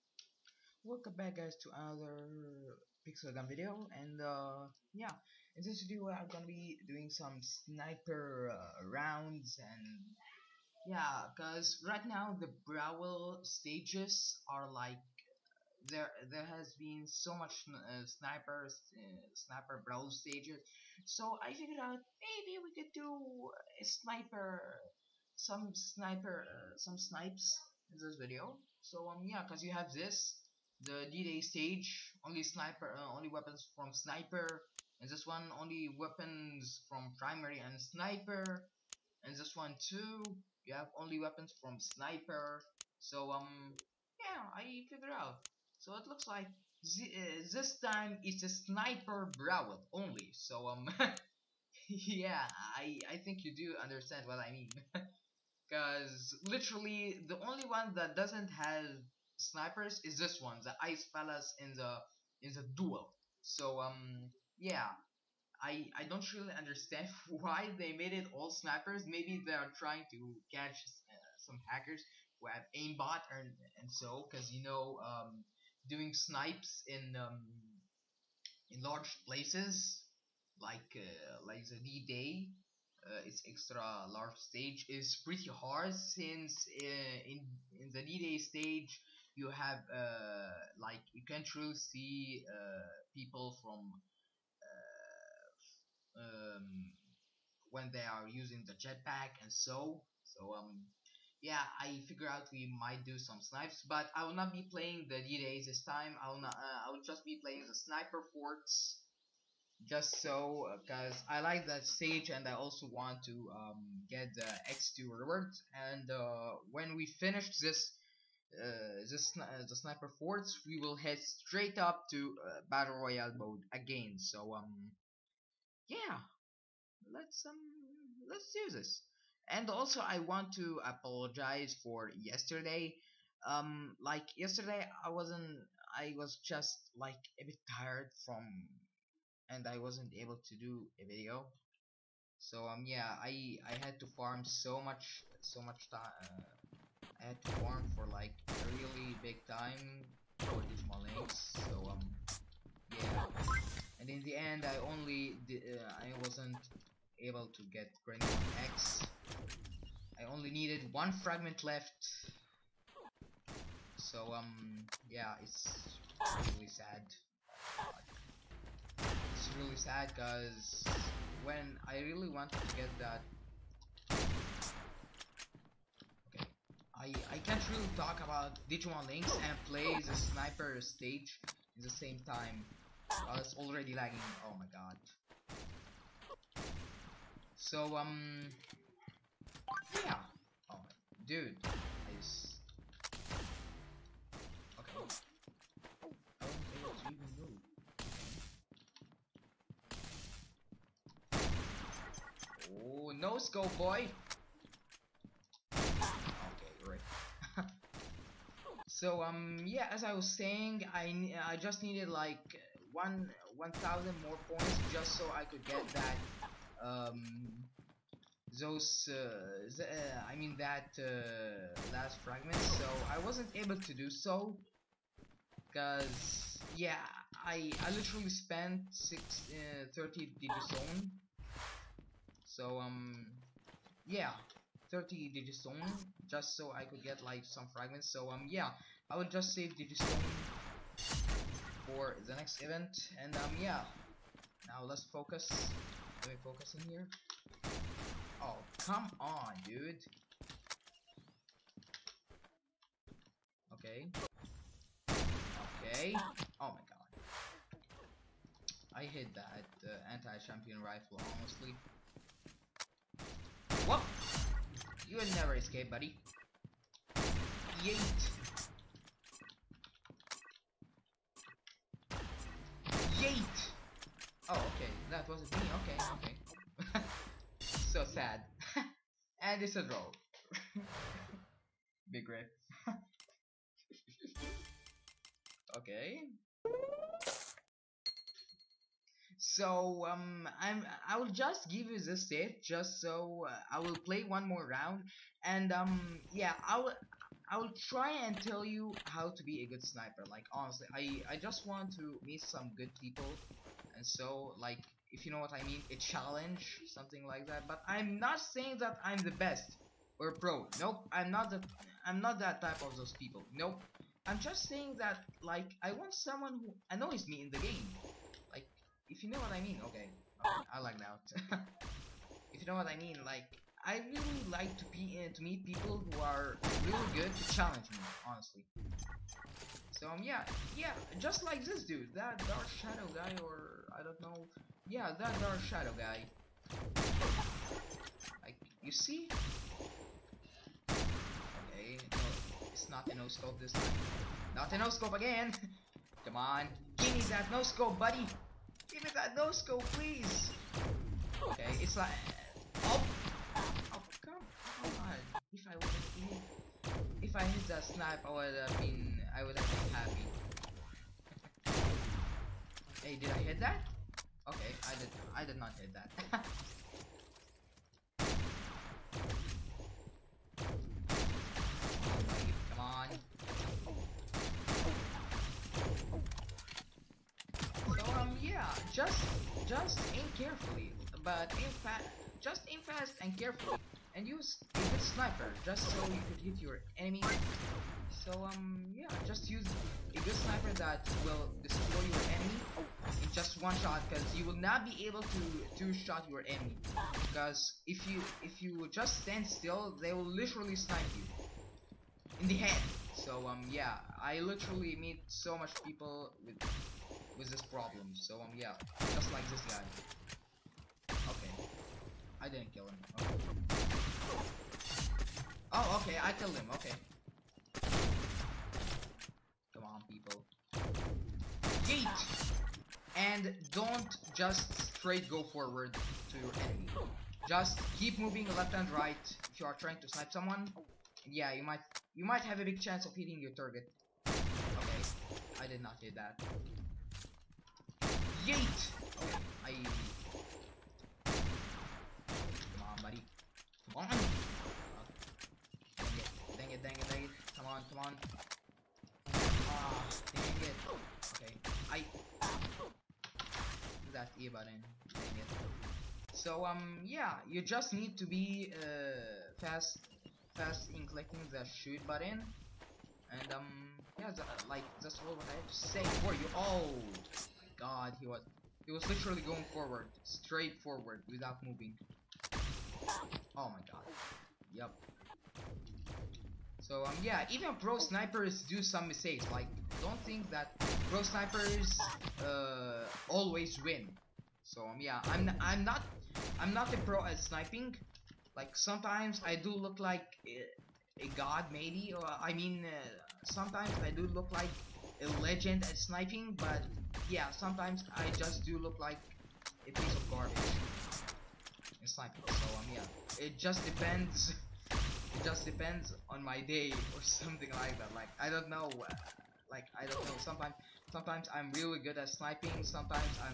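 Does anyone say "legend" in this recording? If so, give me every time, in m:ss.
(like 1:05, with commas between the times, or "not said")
8:15.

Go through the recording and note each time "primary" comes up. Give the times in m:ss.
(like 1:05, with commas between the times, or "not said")
0:37.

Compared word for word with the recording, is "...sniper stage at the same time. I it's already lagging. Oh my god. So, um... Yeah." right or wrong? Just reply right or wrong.
right.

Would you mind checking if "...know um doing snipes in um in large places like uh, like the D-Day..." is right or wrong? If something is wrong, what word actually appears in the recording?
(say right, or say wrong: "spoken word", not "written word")
right.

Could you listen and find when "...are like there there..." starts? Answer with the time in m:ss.
0:14.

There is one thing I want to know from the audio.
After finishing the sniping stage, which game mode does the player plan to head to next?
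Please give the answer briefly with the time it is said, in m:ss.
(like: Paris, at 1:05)
Battle royale, at 2:02.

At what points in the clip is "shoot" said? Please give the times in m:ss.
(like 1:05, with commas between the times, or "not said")
7:41.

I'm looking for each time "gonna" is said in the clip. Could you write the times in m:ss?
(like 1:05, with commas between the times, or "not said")
0:06.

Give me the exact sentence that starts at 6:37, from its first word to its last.
Because if you if you just stand still they will literally snipe you.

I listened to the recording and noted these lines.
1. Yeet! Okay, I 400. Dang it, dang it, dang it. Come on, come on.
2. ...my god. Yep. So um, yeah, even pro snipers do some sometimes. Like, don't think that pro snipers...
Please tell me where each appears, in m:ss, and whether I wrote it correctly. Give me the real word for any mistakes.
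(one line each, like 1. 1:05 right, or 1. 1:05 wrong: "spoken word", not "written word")
1. 7:18 wrong: "100", not "400"
2. 7:53 wrong: "mistakes", not "sometimes".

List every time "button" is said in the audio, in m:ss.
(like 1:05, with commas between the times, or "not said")
7:34, 7:42.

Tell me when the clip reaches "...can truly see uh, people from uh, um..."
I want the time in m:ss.
1:31.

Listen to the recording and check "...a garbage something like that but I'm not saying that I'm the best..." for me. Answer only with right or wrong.
wrong.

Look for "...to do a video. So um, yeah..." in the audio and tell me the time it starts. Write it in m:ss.
2:20.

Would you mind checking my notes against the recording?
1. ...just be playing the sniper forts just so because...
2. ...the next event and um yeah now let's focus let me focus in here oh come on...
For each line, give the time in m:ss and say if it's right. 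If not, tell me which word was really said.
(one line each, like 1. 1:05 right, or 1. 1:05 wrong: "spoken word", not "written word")
1. 1:47 right
2. 4:02 right.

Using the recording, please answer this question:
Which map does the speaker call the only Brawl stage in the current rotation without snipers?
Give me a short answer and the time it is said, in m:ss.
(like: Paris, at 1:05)
Ice palace, at 1:01.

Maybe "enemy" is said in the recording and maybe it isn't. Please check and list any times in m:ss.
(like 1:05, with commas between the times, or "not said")
6:26, 6:32, 6:36, 7:06.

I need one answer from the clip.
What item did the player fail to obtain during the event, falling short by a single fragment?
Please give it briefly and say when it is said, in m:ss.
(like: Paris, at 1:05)
Grenade X, at 2:38.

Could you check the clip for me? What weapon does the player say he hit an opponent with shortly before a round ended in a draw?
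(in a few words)
Anti-champion rifle.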